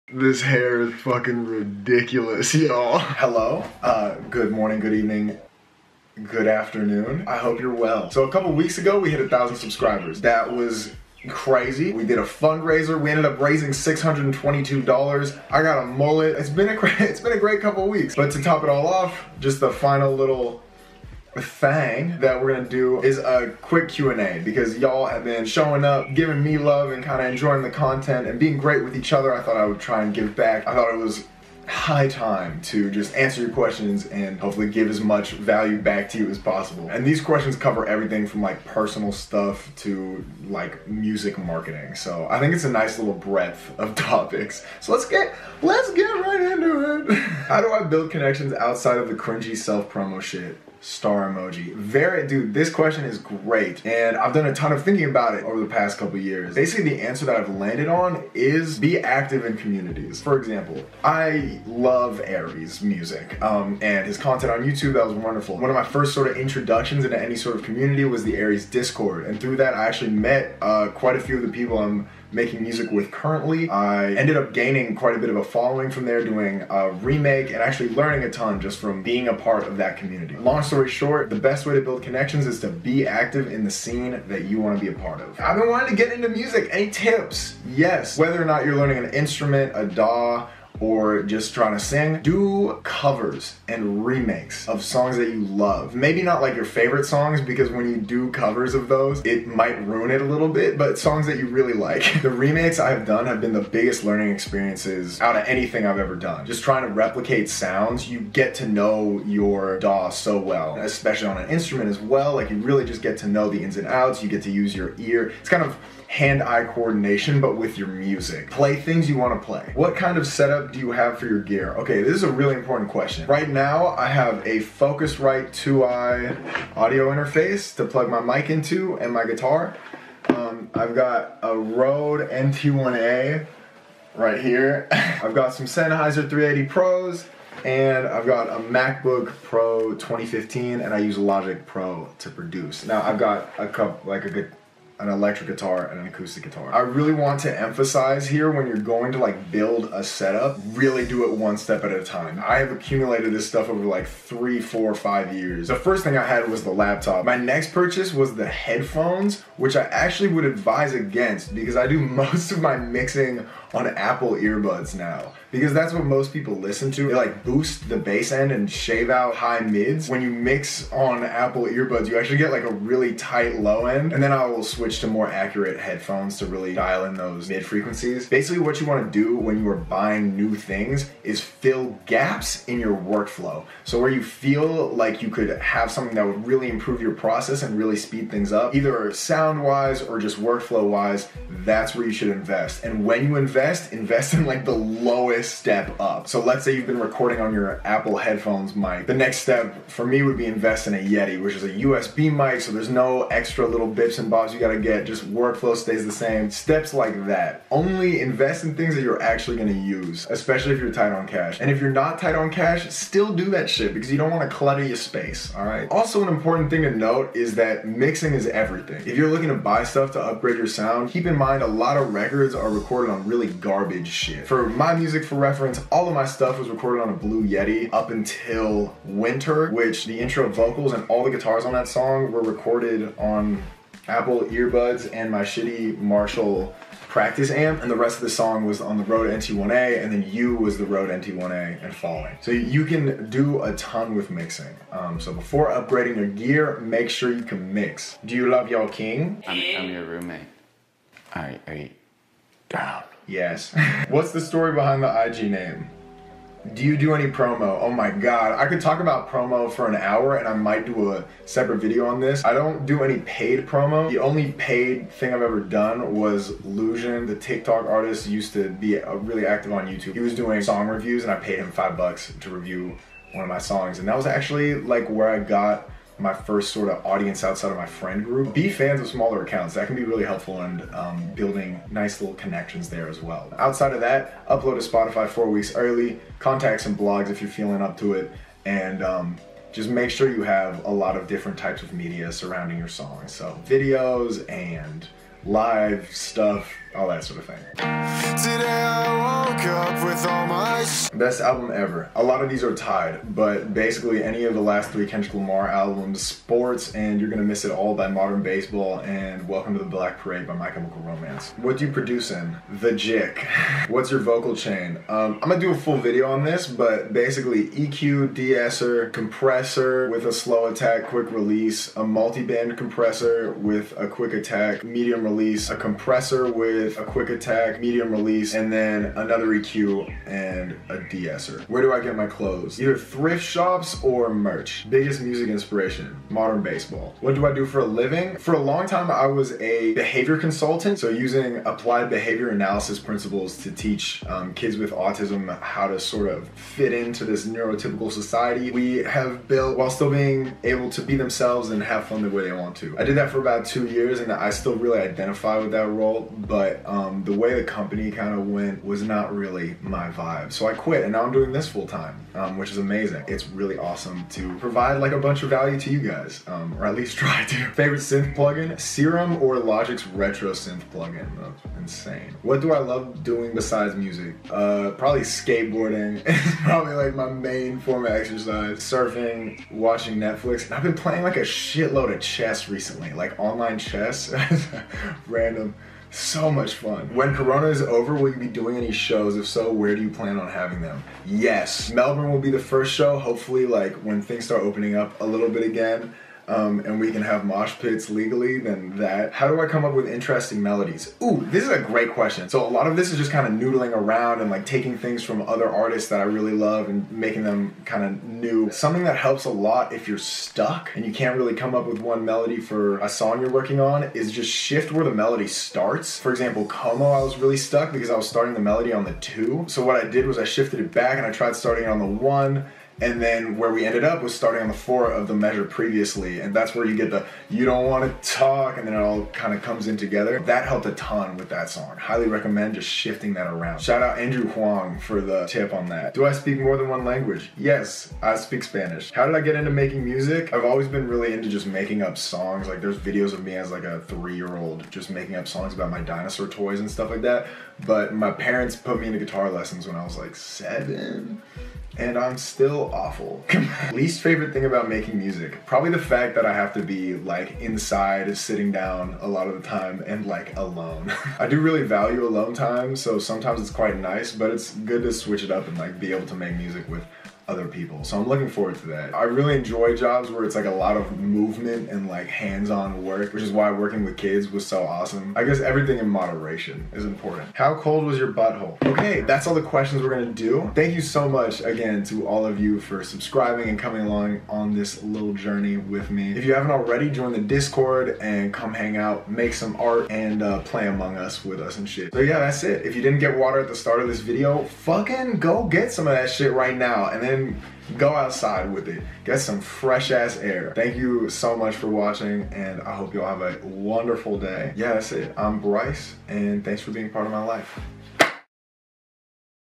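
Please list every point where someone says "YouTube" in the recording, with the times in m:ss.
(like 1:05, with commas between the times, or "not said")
1:04, 4:29.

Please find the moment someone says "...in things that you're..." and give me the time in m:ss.
3:28.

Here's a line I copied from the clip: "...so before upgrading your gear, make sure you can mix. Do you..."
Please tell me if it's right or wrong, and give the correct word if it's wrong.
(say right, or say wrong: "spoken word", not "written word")
right.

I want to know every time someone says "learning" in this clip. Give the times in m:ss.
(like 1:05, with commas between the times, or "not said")
1:17, 1:28, 1:44.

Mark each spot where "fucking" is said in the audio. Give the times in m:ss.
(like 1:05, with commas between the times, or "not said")
0:00, 8:14.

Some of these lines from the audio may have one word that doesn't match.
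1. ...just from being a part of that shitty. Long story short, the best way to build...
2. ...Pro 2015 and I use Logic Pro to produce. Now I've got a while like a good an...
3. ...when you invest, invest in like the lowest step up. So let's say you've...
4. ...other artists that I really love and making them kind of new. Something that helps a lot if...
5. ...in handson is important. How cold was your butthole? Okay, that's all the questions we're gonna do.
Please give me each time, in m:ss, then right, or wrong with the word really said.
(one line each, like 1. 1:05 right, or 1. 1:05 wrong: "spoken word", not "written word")
1. 1:18 wrong: "community", not "shitty"
2. 2:19 wrong: "couple", not "while"
3. 3:13 right
4. 6:45 right
5. 7:55 wrong: "moderation", not "handson".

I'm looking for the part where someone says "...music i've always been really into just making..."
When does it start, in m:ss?
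7:20.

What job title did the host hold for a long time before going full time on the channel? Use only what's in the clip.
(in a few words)
Behavior consultant.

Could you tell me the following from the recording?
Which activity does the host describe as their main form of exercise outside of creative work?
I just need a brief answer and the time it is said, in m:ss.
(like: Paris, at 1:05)
Skateboarding, at 6:15.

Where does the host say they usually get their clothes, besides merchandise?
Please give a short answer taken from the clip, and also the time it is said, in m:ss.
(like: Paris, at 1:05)
Thrift shops, at 5:32.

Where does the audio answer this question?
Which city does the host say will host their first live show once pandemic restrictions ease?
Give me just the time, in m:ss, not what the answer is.
6:31.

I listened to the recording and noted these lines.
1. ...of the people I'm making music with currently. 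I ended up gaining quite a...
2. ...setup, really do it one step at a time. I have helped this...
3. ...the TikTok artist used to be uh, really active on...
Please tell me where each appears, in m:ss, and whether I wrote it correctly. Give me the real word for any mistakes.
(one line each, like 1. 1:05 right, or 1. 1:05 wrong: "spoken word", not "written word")
1. 1:11 right
2. 2:30 wrong: "accumulated", not "helped"
3. 4:27 right.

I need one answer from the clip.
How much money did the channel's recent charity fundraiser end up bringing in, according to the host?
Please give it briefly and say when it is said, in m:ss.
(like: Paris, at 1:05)
$622, at 0:13.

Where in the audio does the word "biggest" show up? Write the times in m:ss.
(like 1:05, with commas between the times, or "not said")
1:43, 5:34.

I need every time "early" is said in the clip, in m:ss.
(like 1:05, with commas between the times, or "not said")
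4:45.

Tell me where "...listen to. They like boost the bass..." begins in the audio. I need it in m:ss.
2:46.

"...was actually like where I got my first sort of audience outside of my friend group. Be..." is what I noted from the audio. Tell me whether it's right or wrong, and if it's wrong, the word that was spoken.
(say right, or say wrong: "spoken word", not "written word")
right.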